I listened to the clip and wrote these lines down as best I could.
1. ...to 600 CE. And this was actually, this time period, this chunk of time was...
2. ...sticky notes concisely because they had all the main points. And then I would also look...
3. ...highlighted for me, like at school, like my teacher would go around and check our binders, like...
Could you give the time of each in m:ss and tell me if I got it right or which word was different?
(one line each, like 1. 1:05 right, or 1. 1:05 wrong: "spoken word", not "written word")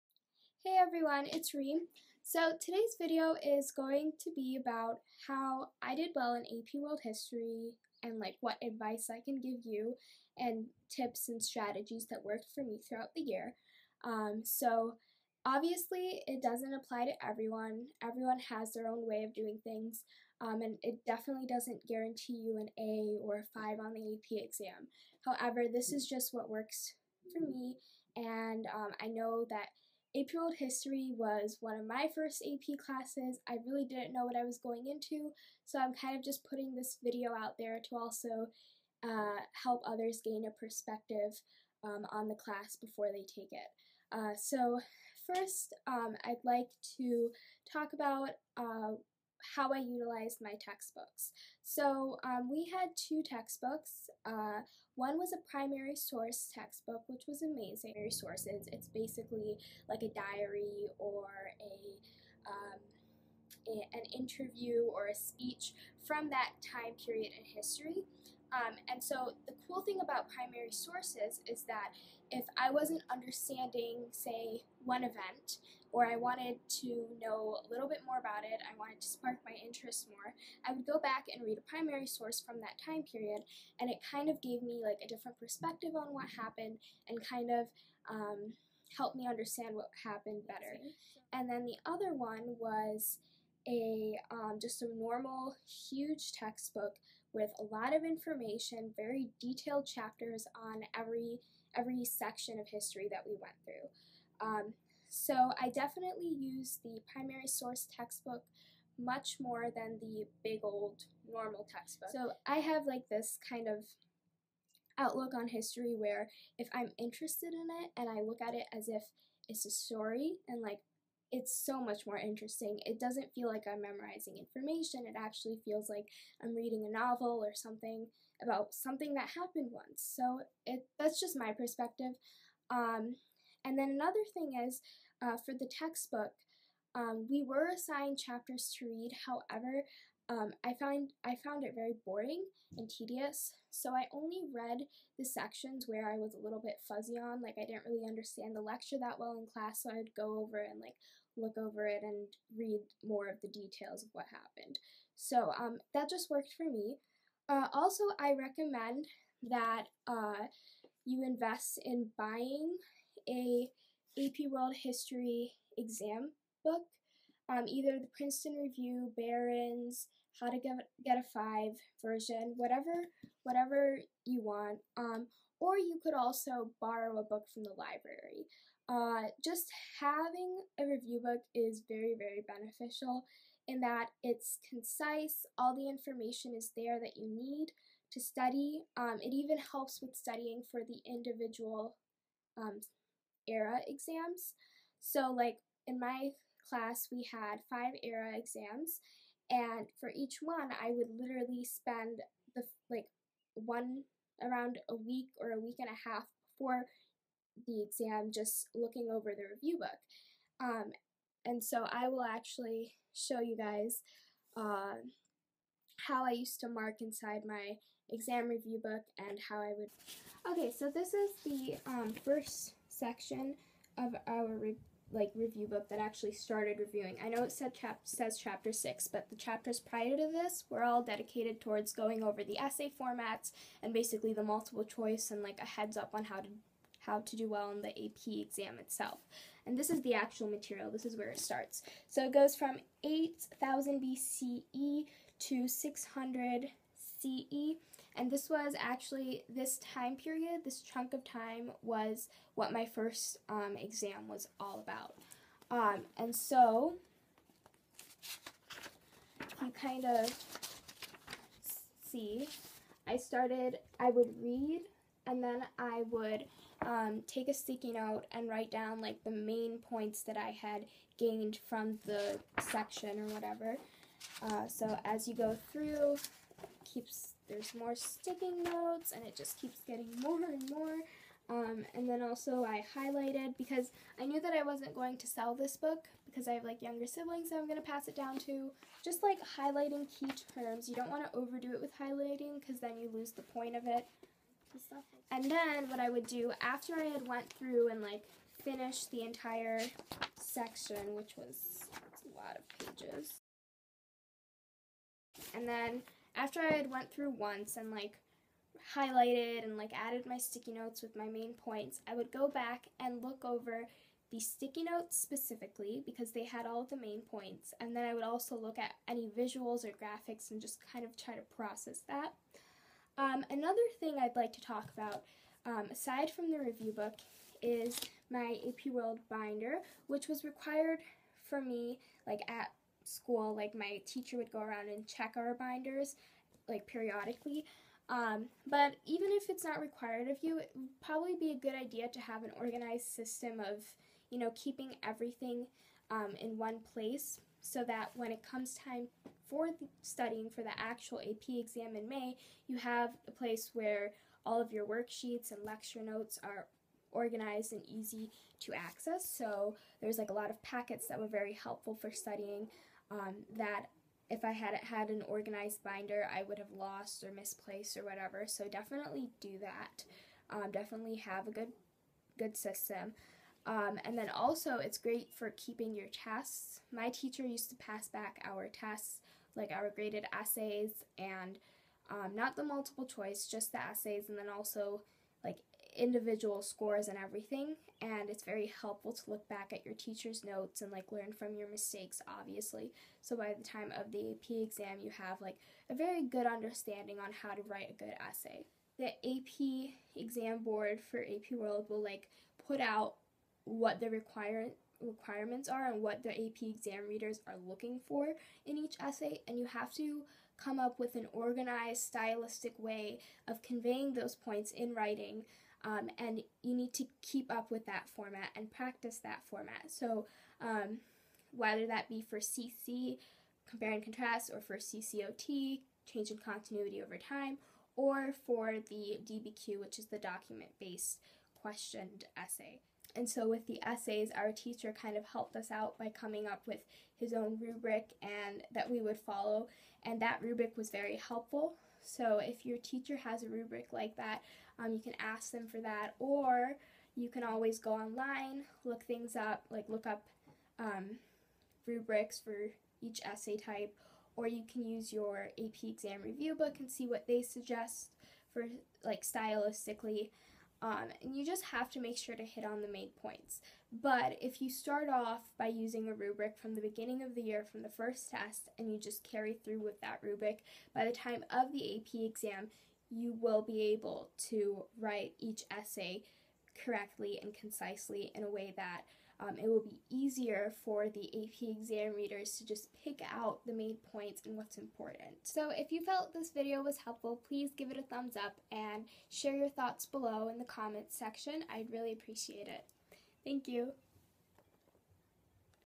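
1. 4:05 right
2. 5:14 wrong: "specifically", not "concisely"
3. 5:30 wrong: "required", not "highlighted".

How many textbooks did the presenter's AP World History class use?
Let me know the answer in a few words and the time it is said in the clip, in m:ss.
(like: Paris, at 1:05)
2, at 0:52.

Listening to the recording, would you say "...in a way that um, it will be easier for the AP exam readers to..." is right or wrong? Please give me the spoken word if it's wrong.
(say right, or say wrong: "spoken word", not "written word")
right.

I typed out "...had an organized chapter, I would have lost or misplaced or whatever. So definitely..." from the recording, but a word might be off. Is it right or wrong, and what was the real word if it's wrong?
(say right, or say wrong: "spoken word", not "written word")
wrong: "binder", not "chapter".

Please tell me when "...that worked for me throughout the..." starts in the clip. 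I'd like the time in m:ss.
0:12.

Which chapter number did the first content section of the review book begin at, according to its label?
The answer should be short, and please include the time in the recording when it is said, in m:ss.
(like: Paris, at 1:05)
6, at 3:48.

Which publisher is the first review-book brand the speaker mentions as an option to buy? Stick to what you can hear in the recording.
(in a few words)
Princeton Review.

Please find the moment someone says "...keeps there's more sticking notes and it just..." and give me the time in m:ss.
4:36.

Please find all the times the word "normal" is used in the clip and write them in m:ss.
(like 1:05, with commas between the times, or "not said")
1:34, 1:51.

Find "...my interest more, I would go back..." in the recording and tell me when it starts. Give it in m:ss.
1:19.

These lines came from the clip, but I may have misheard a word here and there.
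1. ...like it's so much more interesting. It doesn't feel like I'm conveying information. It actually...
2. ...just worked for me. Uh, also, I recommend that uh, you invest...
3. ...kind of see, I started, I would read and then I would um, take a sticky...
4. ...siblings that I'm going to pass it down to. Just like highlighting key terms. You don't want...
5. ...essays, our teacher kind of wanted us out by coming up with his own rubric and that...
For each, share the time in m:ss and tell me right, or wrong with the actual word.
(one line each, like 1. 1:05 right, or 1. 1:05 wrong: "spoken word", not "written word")
1. 2:00 wrong: "memorizing", not "conveying"
2. 2:36 right
3. 4:19 right
4. 4:47 right
5. 7:13 wrong: "helped", not "wanted".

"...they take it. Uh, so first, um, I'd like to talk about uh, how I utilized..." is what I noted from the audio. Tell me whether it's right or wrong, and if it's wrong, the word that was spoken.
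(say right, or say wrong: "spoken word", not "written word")
right.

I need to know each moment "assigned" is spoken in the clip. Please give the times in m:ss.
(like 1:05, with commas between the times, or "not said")
2:17.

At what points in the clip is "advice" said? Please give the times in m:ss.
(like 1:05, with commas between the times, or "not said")
0:08.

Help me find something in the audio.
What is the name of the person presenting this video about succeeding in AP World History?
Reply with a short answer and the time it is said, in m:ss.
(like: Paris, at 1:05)
Reem, at 0:01.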